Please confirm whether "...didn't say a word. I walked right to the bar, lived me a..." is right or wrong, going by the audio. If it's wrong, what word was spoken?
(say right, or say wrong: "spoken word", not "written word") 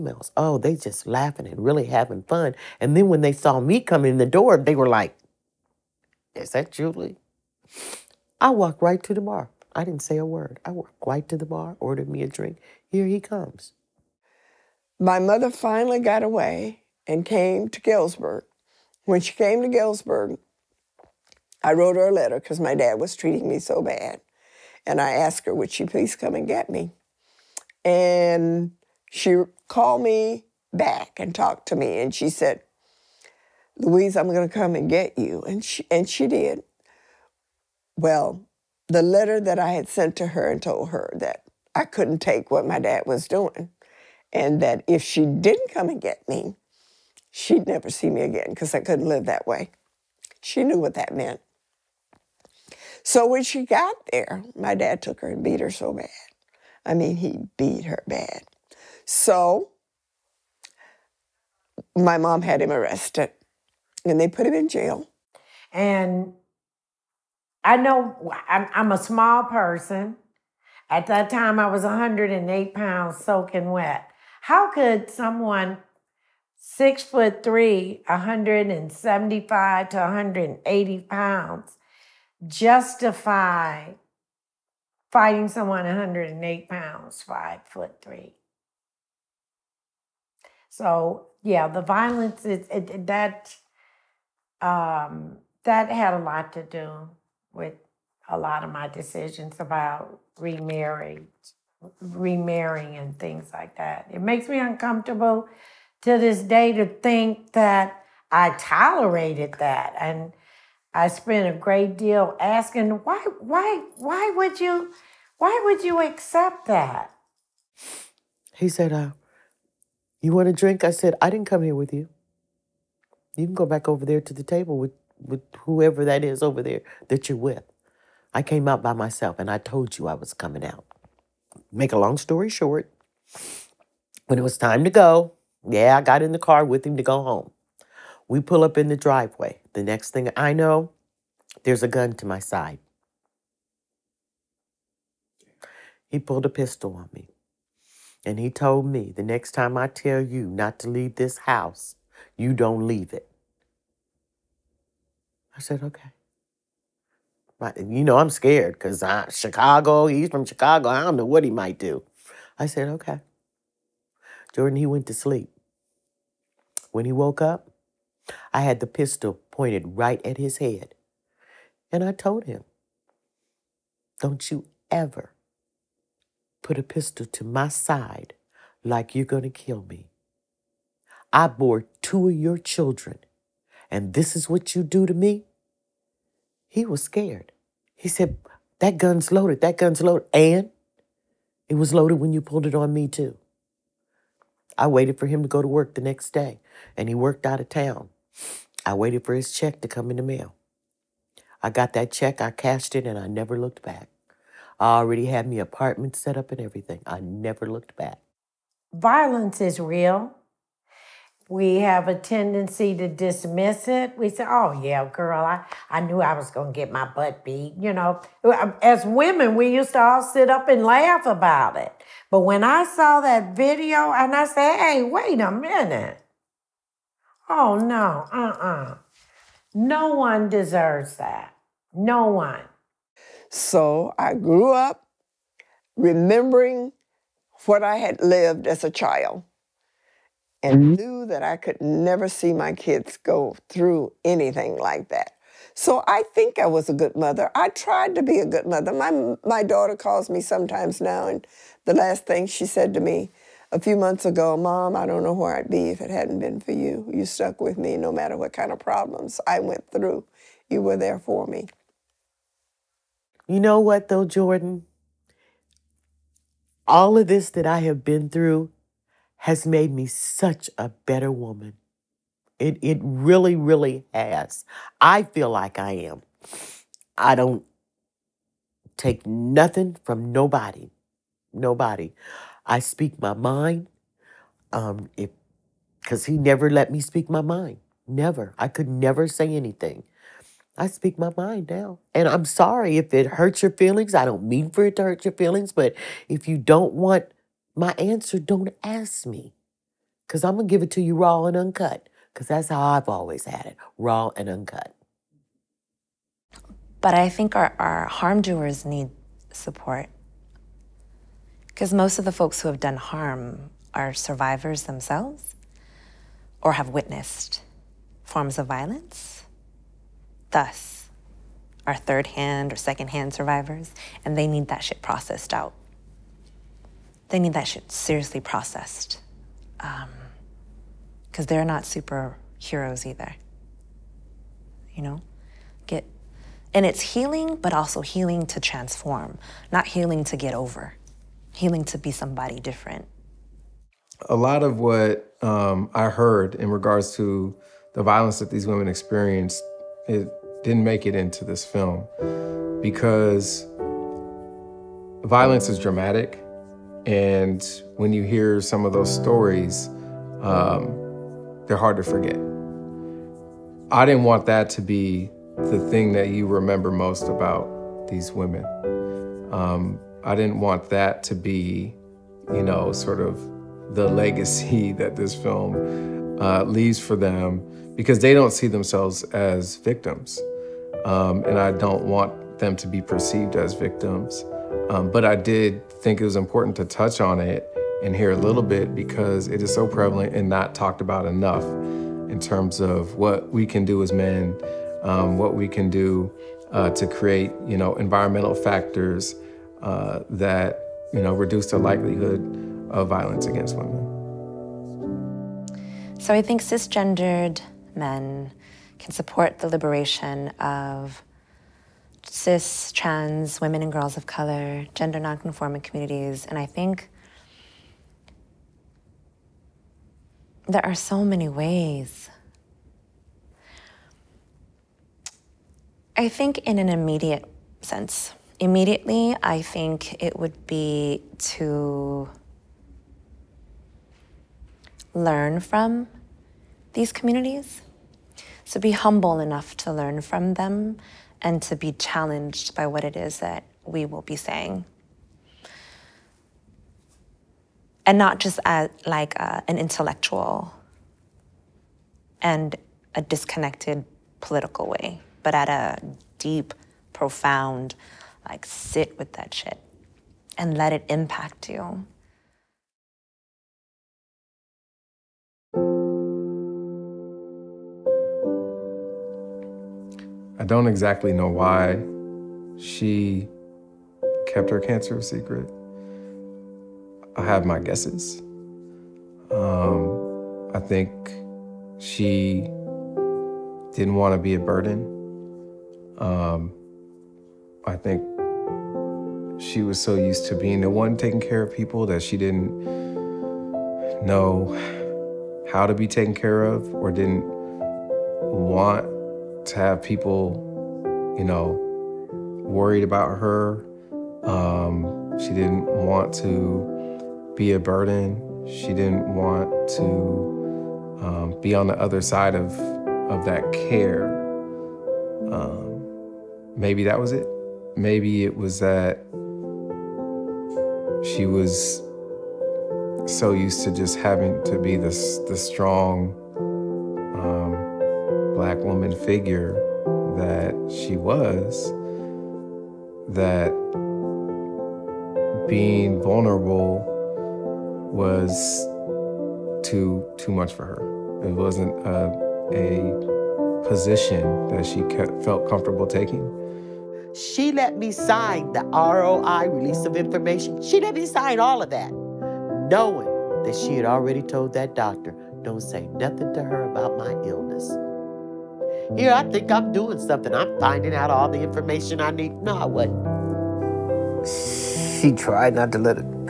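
wrong: "ordered", not "lived".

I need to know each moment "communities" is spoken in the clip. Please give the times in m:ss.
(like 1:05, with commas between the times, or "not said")
6:55, 7:17.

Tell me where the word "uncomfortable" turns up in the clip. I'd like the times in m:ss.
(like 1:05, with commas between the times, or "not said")
1:44.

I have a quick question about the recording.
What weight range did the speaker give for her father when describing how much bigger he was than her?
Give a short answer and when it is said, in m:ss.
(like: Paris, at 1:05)
175 to 180 pounds, at 1:18.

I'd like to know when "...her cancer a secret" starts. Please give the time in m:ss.
7:54.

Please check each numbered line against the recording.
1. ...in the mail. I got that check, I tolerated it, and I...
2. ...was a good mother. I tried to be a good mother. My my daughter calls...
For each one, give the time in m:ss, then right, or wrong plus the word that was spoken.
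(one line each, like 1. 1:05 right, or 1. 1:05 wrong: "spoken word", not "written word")
1. 3:20 wrong: "cashed", not "tolerated"
2. 4:06 right.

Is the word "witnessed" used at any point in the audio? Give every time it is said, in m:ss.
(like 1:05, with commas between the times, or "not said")
5:16.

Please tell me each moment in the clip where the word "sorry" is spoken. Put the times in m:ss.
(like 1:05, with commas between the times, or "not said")
4:52.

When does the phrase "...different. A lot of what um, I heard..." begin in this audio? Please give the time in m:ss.
5:42.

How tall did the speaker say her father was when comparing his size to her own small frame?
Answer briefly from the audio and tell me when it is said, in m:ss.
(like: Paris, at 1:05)
six foot three, at 1:16.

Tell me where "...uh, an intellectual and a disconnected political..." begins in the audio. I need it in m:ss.
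7:29.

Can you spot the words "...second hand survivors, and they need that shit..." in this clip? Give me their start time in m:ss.
5:22.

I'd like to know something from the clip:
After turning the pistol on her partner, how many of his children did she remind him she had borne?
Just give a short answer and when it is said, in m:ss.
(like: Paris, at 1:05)
2, at 3:02.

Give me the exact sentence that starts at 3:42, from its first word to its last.
But when I saw that video and I said, hey, wait a minute.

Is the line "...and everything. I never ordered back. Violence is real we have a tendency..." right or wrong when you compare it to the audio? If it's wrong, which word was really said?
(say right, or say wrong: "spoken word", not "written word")
wrong: "looked", not "ordered".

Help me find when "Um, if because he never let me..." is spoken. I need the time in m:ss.
4:44.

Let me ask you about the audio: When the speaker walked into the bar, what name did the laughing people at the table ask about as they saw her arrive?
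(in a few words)
Julie.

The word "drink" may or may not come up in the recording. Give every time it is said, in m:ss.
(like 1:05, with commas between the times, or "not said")
0:12, 2:00.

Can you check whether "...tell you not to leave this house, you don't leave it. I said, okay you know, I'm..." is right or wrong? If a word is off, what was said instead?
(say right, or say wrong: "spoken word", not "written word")
right.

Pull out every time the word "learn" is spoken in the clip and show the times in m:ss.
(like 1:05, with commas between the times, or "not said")
7:15, 7:19.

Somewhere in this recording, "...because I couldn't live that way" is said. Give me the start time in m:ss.
0:48.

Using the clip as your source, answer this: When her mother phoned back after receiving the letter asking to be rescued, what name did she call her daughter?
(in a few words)
Louise.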